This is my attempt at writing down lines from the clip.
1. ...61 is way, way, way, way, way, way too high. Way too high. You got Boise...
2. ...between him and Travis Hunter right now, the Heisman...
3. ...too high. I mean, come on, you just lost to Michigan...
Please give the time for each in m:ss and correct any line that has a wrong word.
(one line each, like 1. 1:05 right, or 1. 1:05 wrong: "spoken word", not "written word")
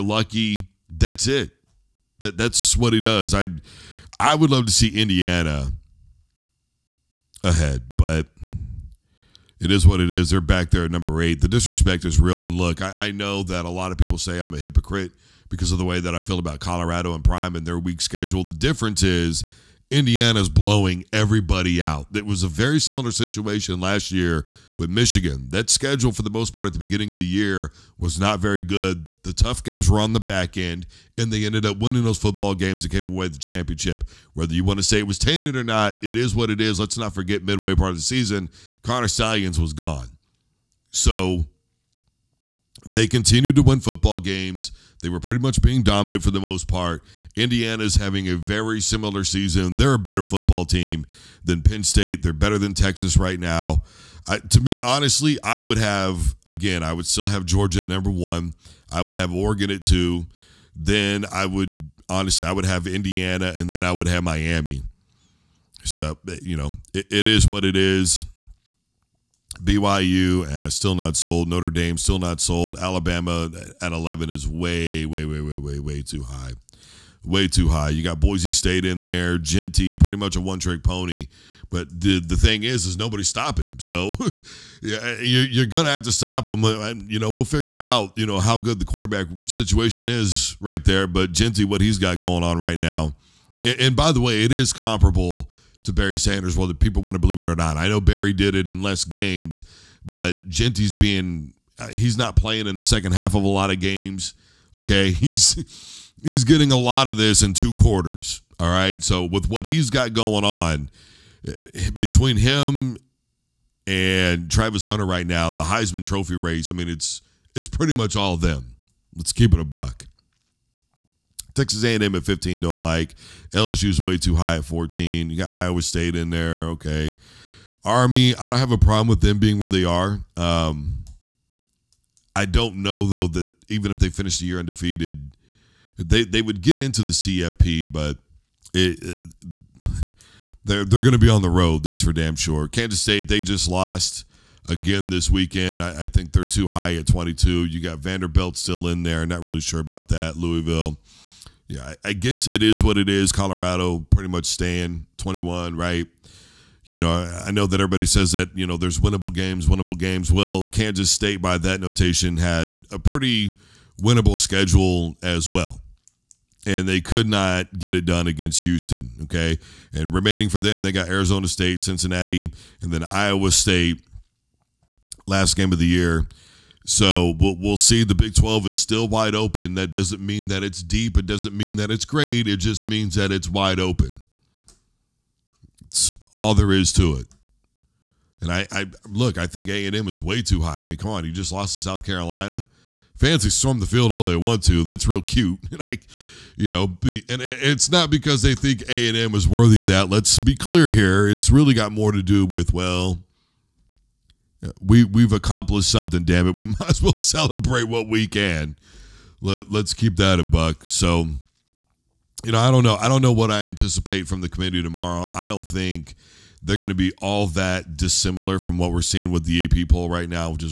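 1. 1:13 wrong: "11", not "61"
2. 1:51 right
3. 3:10 wrong: "South", not "Michigan".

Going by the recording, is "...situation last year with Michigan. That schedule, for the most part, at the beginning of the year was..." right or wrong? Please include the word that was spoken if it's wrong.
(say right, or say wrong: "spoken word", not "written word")
right.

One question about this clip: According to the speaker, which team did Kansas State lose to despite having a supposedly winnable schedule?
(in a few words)
Houston.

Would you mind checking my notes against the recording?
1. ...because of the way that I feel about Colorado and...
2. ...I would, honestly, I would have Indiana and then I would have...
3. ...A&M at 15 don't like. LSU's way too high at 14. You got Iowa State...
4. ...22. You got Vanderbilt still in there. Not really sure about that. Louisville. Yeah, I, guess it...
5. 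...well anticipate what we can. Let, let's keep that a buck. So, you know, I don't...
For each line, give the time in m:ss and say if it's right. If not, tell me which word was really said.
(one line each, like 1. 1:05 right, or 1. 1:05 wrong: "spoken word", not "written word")
1. 0:15 right
2. 1:01 right
3. 2:01 right
4. 2:27 right
5. 3:27 wrong: "celebrate", not "anticipate".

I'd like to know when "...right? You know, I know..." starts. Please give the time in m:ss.
2:35.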